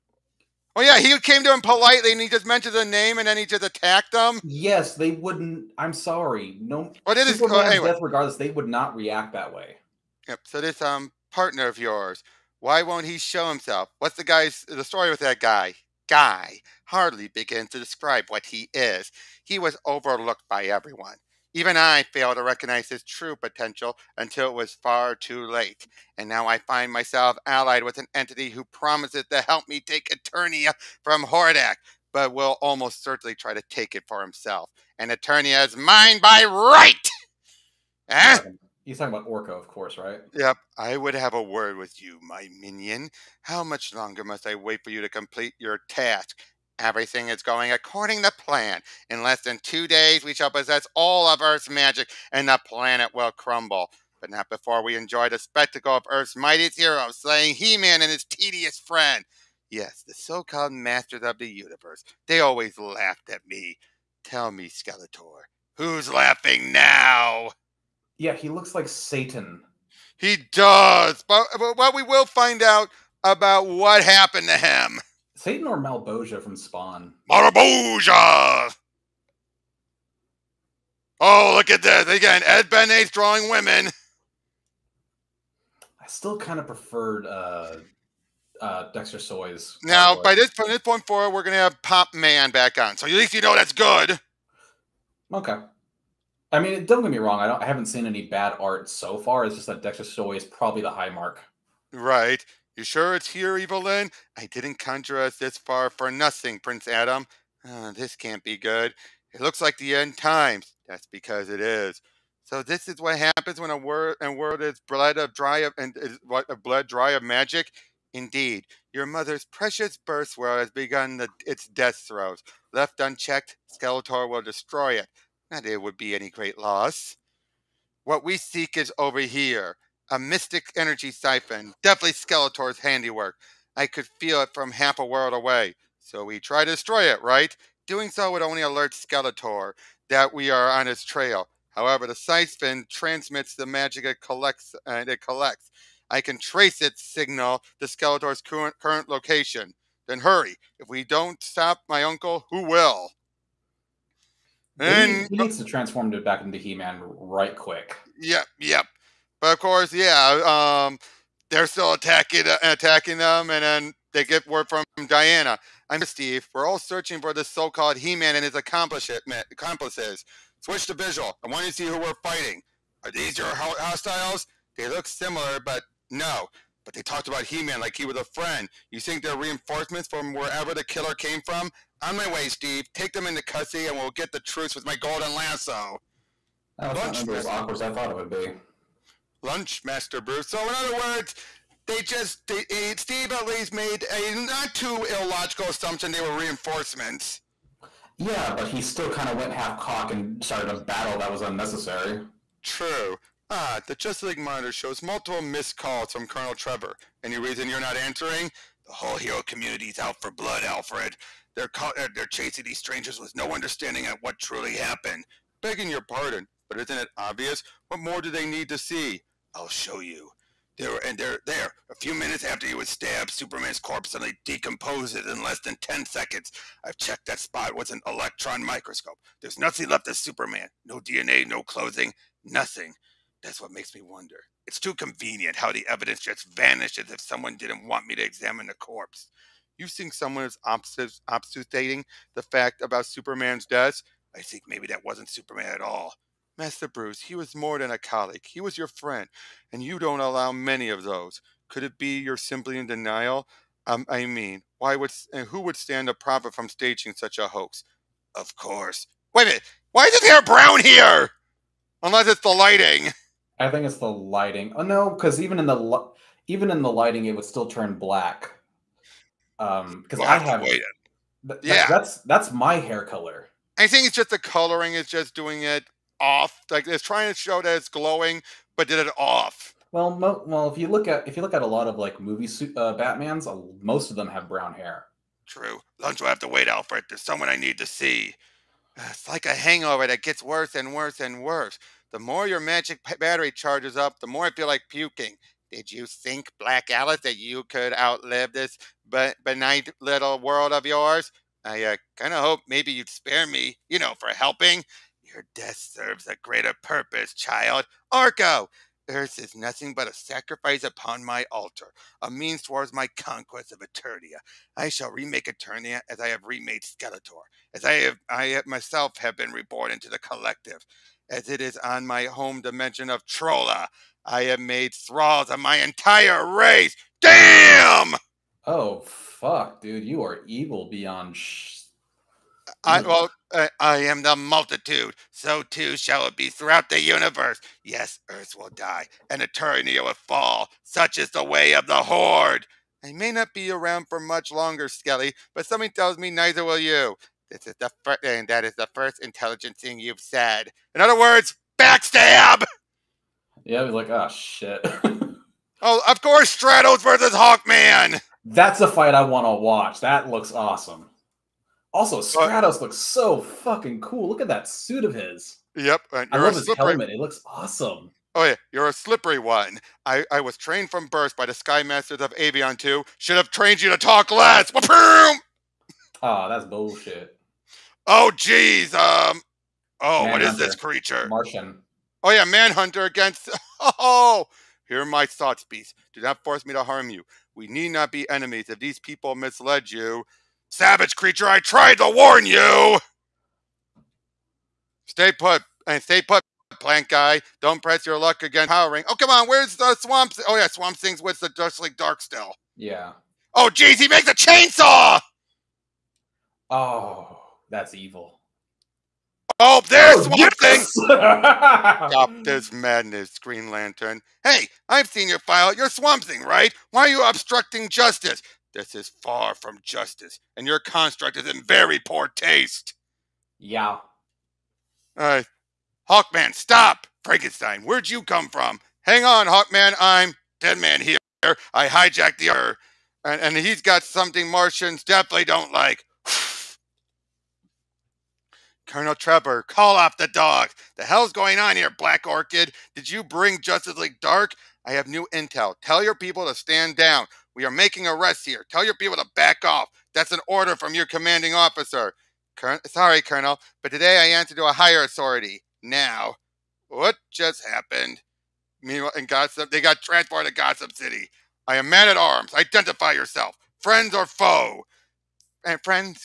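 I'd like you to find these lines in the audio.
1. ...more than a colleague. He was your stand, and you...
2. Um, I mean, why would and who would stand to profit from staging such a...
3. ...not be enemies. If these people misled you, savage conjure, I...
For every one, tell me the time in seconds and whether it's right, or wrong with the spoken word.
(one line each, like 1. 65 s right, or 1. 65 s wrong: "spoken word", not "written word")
1. 247 s wrong: "friend", not "stand"
2. 253 s right
3. 387 s wrong: "creature", not "conjure".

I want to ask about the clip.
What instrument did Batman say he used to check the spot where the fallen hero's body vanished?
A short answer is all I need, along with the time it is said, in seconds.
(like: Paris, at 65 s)
electron microscope, at 228 s.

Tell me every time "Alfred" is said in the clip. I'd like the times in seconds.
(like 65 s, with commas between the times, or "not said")
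210 s, 286 s.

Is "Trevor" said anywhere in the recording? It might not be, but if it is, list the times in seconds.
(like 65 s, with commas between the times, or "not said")
206 s, 439 s.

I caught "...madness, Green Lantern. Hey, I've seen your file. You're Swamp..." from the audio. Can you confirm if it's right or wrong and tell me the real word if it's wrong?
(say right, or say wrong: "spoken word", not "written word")
right.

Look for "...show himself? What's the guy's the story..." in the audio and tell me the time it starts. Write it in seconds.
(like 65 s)
13 s.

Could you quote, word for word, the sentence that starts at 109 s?
It looks like the end times.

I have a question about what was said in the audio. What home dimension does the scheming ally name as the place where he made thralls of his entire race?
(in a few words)
Trolla.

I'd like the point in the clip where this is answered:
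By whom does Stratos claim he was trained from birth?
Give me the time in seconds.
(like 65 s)
371 s.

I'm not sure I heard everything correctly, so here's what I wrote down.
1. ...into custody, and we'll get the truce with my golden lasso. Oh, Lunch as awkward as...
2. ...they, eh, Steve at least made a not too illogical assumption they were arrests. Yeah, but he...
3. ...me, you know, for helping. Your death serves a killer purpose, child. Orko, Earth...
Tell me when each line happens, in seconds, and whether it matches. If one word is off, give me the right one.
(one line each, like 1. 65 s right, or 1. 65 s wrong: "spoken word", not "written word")
1. 183 s right
2. 192 s wrong: "reinforcements", not "arrests"
3. 303 s wrong: "greater", not "killer".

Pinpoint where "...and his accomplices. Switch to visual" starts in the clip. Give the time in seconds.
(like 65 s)
168 s.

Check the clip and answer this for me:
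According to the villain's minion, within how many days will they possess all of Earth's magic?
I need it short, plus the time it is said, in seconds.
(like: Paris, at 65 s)
2, at 49 s.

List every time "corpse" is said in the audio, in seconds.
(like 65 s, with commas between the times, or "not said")
223 s, 238 s.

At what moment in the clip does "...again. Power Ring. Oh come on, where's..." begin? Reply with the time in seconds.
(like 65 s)
398 s.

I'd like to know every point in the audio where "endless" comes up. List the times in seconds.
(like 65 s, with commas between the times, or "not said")
not said.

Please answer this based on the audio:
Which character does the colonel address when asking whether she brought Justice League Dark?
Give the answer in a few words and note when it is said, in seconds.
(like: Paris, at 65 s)
Black Orchid, at 441 s.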